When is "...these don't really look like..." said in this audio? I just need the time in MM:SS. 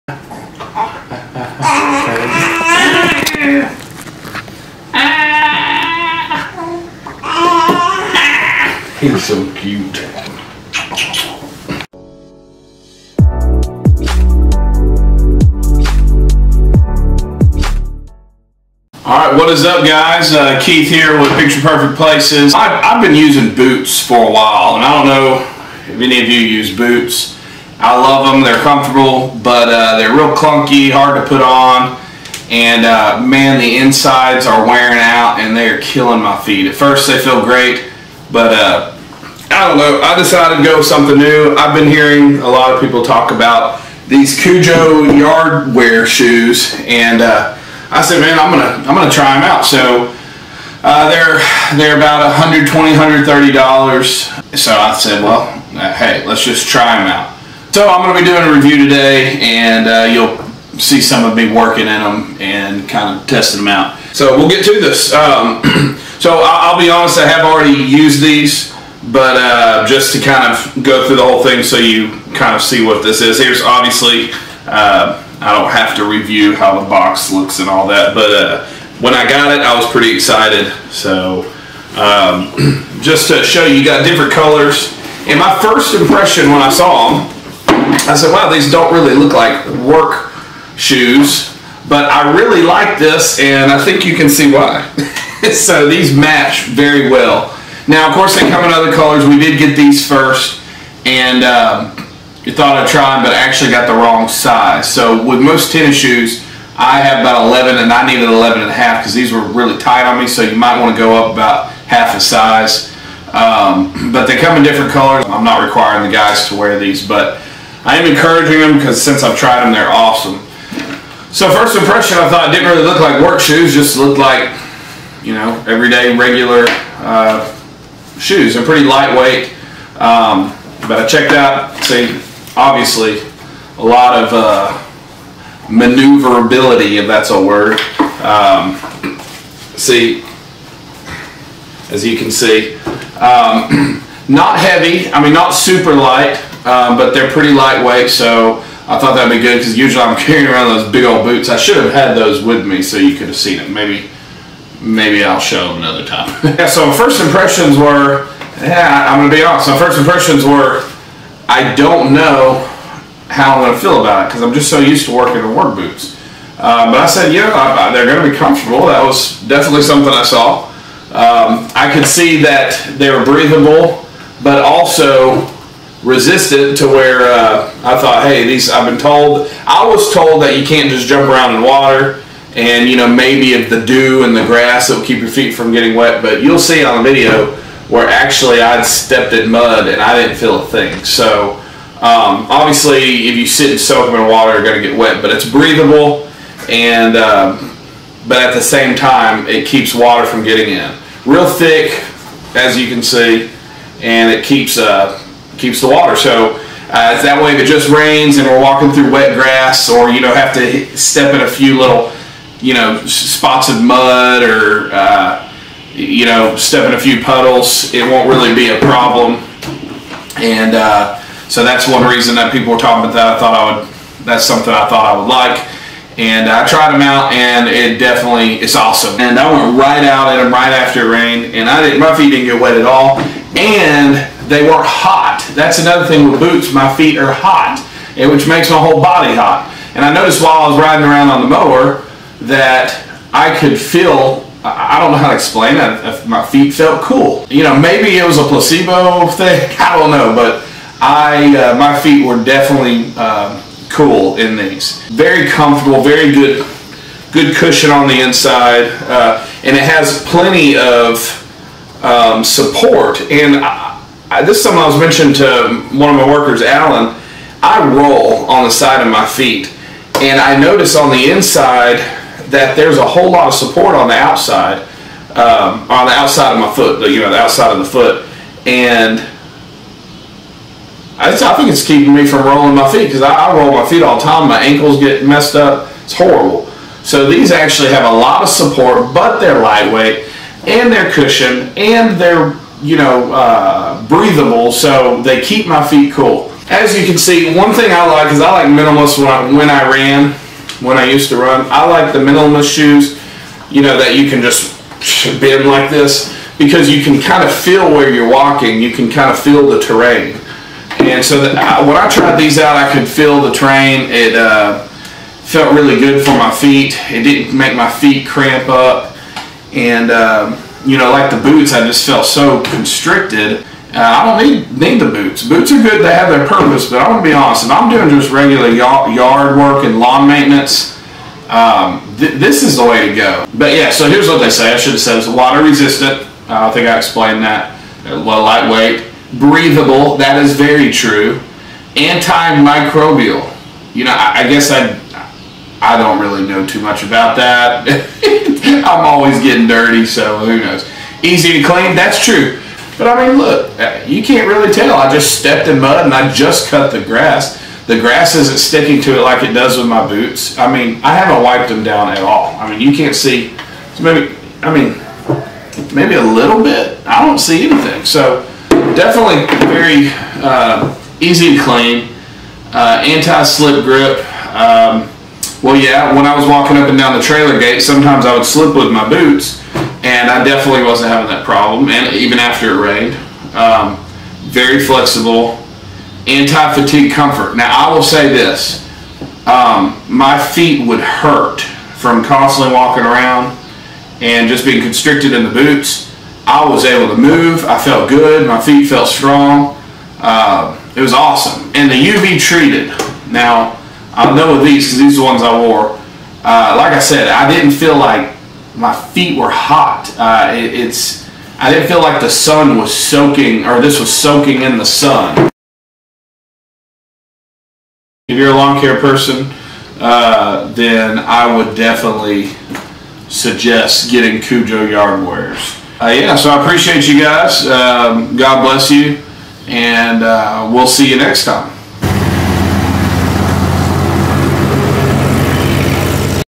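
01:28.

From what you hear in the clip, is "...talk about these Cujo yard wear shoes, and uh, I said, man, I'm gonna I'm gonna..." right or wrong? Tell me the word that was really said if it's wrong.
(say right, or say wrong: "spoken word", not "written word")
right.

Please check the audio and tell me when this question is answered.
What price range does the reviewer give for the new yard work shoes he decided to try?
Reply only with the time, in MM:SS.
00:52.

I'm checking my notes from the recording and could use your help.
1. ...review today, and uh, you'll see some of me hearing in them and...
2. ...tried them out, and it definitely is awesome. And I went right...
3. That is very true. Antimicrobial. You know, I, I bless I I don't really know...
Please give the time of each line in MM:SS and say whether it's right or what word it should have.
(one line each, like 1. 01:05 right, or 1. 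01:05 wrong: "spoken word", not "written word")
1. 00:58 wrong: "working", not "hearing"
2. 03:46 right
3. 05:40 wrong: "guess", not "bless".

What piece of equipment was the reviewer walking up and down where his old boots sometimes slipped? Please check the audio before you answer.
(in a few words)
Trailer gate.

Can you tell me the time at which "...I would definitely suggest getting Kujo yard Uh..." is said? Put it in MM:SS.
07:01.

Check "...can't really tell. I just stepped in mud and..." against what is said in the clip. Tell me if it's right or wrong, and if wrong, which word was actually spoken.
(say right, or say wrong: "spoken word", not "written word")
right.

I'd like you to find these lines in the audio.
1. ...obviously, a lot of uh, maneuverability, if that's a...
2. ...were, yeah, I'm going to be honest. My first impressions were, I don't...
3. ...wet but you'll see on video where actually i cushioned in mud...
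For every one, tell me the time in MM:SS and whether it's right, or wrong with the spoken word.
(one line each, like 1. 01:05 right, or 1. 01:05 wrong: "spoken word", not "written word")
1. 02:12 right
2. 02:37 right
3. 03:05 wrong: "stepped", not "cushioned".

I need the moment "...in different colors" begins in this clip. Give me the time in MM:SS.
01:54.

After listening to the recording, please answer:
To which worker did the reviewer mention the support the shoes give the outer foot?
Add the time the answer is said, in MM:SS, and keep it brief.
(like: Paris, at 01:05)
Alan, at 04:26.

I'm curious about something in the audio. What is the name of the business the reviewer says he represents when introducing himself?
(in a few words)
Picture Perfect Places.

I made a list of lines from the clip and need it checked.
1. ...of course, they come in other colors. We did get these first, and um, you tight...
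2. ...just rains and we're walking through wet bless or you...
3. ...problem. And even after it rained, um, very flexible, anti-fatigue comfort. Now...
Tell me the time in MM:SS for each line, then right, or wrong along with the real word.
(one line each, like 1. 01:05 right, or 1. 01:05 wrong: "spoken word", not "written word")
1. 01:38 wrong: "thought", not "tight"
2. 03:27 wrong: "grass", not "bless"
3. 06:21 right.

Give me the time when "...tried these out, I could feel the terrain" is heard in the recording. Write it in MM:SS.
05:12.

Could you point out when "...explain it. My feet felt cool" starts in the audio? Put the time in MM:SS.
04:05.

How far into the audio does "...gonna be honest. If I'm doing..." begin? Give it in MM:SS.
05:27.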